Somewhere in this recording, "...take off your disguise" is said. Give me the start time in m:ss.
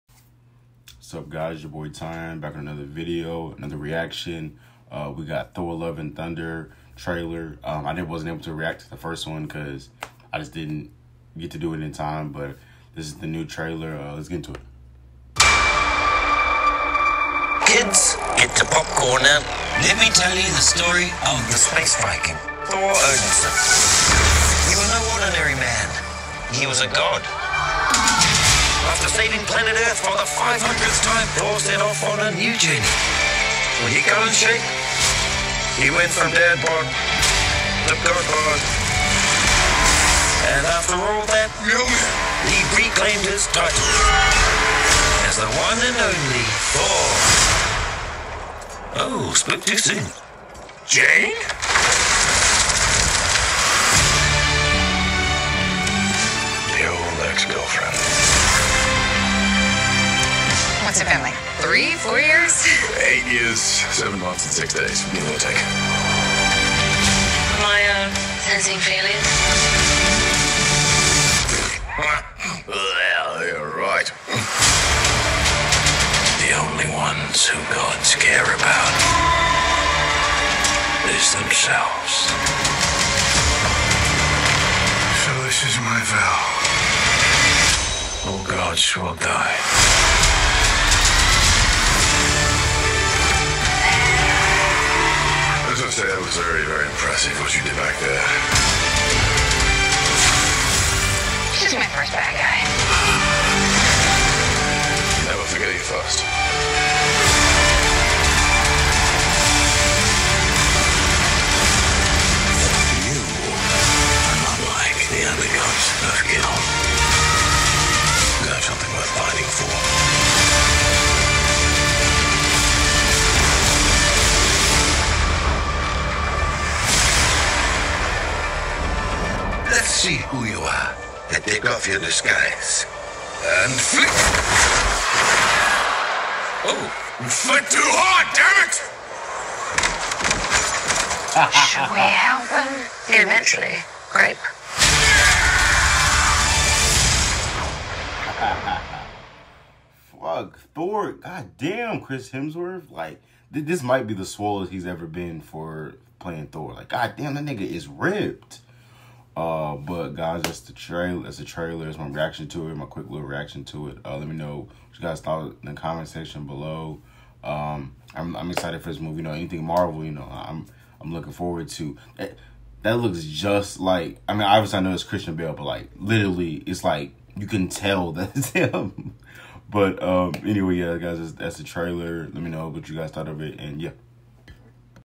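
2:11.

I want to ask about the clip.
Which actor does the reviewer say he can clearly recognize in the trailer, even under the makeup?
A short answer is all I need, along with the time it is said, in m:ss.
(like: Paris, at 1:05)
Christian Bale, at 2:55.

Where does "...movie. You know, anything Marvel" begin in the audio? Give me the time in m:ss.
2:48.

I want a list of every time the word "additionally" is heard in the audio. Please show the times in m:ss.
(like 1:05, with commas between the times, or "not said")
not said.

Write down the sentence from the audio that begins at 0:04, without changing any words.
Uh, we got Thor Love and Thunder trailer.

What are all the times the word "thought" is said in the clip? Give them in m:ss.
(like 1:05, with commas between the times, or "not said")
2:45, 3:03.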